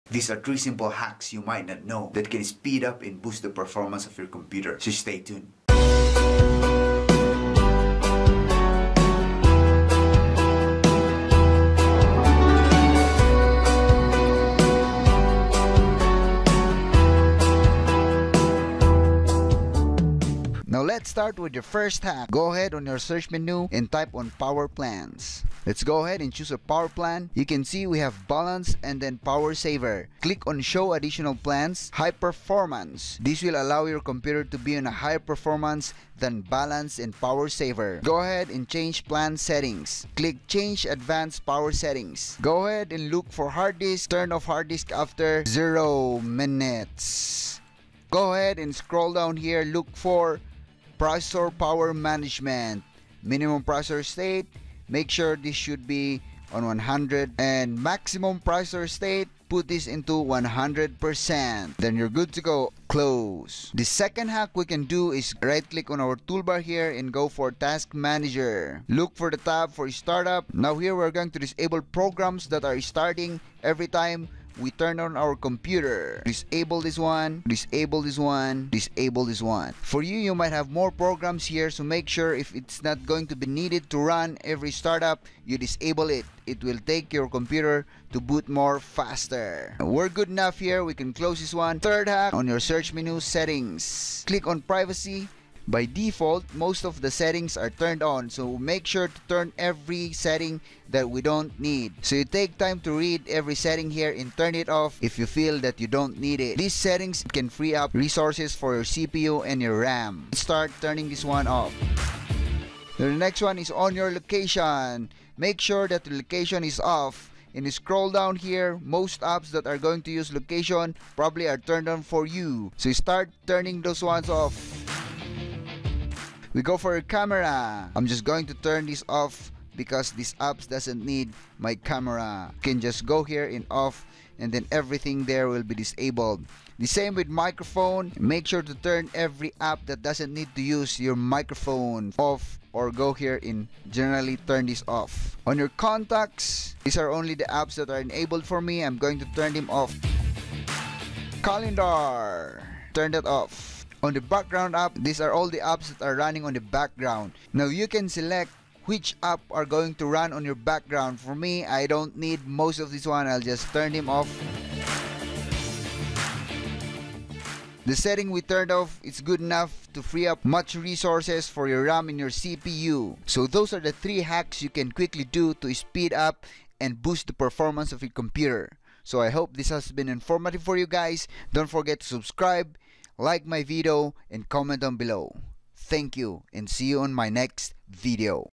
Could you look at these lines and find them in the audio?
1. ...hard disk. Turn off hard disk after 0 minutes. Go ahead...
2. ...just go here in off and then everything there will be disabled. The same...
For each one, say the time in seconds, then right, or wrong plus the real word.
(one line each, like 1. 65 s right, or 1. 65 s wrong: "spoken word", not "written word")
1. 43 s right
2. 132 s right.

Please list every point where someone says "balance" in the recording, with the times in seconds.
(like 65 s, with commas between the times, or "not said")
28 s, 36 s.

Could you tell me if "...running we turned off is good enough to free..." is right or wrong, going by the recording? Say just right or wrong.
wrong.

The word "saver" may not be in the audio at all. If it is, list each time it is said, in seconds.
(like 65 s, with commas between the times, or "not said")
29 s, 37 s.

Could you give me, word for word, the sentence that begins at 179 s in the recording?
So I hope this has been informative for you guys.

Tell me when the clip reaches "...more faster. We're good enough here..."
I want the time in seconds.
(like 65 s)
88 s.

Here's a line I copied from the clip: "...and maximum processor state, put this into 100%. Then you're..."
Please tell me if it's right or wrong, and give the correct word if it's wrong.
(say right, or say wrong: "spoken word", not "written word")
right.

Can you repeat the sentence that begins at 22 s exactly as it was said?
Go ahead on your search menu and type on power plans.